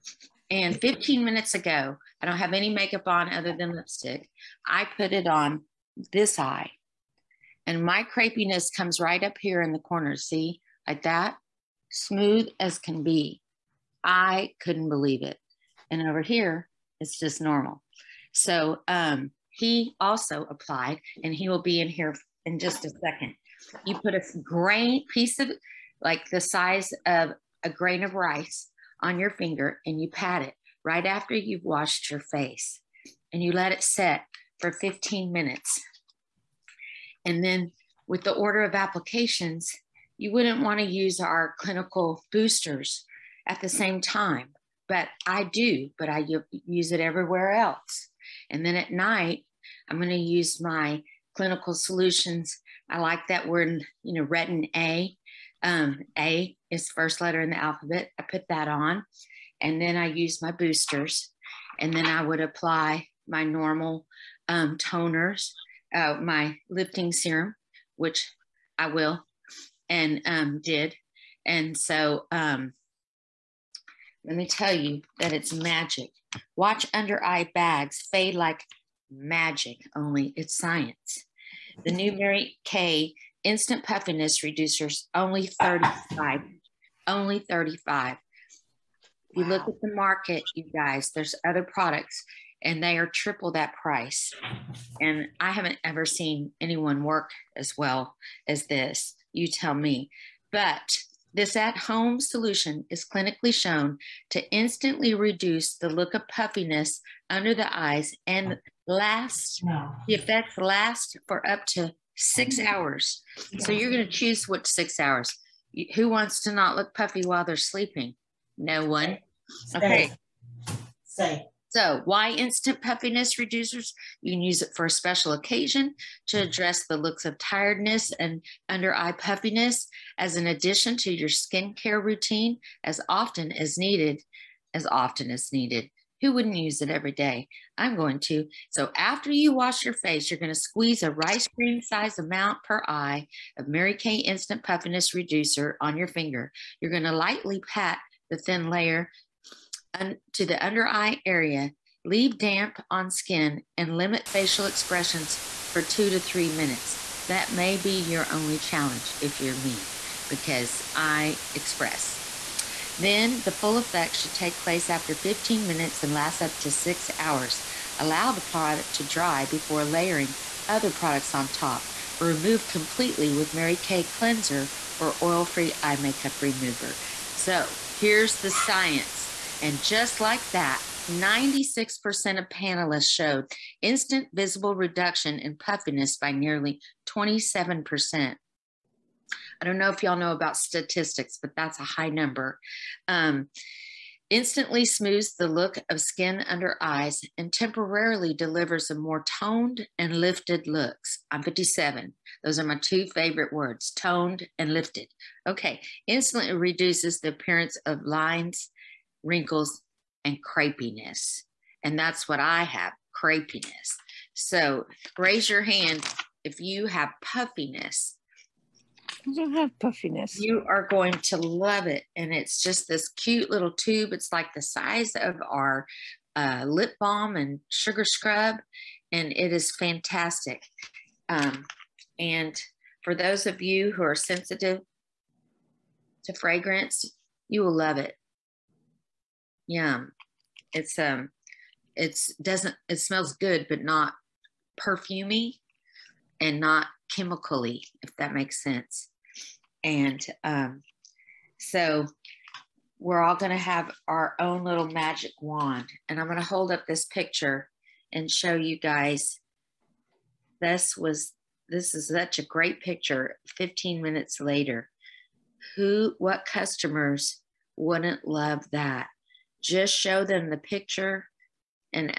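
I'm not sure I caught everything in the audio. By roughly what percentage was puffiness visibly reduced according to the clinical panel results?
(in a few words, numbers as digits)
27%.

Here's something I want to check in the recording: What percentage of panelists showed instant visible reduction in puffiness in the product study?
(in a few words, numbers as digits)
96%.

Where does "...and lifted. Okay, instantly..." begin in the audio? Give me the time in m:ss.
3:24.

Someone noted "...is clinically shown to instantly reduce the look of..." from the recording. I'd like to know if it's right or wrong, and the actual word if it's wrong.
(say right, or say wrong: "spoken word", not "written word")
right.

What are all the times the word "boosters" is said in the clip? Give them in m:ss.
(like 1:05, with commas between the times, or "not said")
0:42, 1:00.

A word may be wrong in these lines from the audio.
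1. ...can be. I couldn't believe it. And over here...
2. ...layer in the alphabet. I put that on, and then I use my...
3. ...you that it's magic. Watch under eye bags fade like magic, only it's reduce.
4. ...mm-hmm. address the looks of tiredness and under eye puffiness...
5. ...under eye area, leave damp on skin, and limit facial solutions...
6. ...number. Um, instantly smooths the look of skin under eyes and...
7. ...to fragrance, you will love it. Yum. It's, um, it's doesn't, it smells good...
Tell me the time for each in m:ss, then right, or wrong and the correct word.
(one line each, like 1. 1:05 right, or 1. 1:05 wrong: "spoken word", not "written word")
1. 0:12 right
2. 0:57 wrong: "letter", not "layer"
3. 1:14 wrong: "science", not "reduce"
4. 2:06 right
5. 2:30 wrong: "expressions", not "solutions"
6. 3:12 right
7. 3:56 right.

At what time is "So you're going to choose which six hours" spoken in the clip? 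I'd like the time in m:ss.
1:53.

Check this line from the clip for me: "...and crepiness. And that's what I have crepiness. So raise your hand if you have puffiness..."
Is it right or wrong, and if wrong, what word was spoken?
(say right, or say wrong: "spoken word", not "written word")
right.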